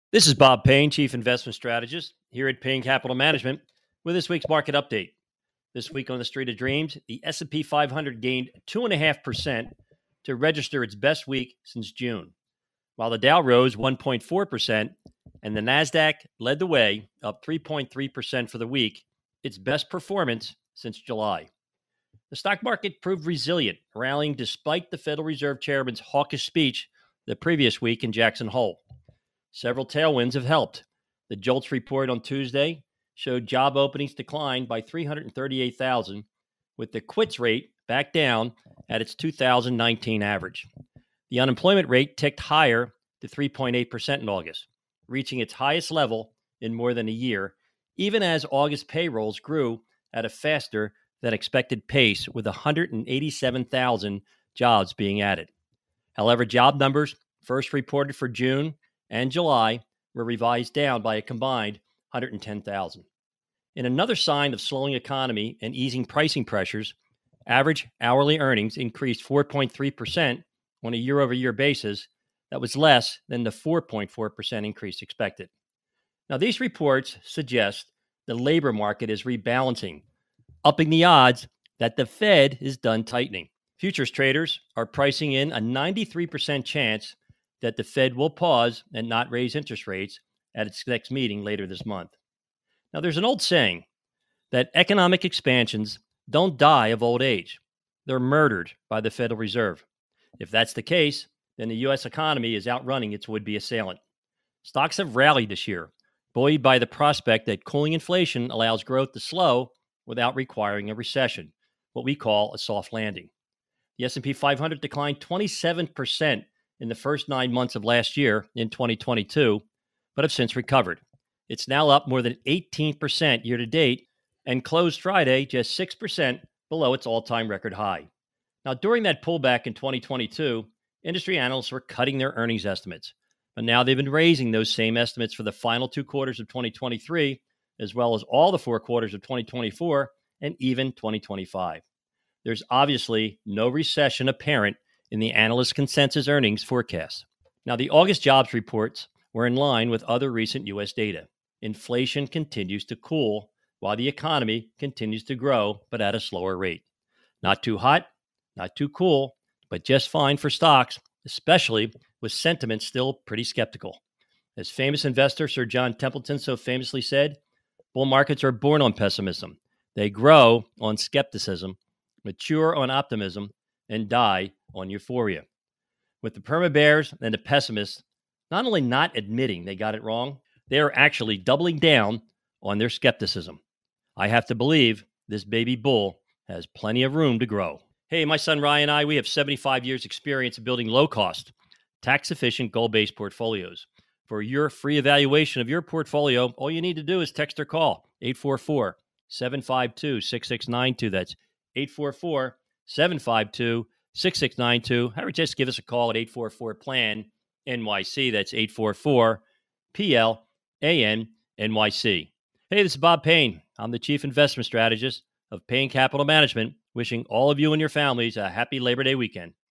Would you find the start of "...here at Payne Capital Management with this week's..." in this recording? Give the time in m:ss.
0:02.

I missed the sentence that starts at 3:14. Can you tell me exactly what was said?
For your free evaluation of your portfolio, all you need to do is text or call 844 752 6692.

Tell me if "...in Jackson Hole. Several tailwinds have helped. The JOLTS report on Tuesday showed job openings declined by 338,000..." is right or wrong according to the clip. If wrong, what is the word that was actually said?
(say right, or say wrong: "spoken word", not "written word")
right.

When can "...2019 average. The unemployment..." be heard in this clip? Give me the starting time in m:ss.
0:39.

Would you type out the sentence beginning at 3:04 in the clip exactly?
I have to believe this baby bull has plenty of room to grow.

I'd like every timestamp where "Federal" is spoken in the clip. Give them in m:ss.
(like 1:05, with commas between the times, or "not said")
0:24, 1:39.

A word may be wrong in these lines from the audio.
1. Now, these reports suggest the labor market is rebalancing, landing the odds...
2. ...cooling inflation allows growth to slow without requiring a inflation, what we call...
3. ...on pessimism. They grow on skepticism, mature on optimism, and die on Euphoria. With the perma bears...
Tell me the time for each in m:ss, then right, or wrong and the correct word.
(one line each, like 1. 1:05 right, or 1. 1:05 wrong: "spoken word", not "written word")
1. 1:16 wrong: "upping", not "landing"
2. 1:47 wrong: "recession", not "inflation"
3. 2:48 right.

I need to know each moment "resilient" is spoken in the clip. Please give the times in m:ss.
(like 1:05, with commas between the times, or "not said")
0:23.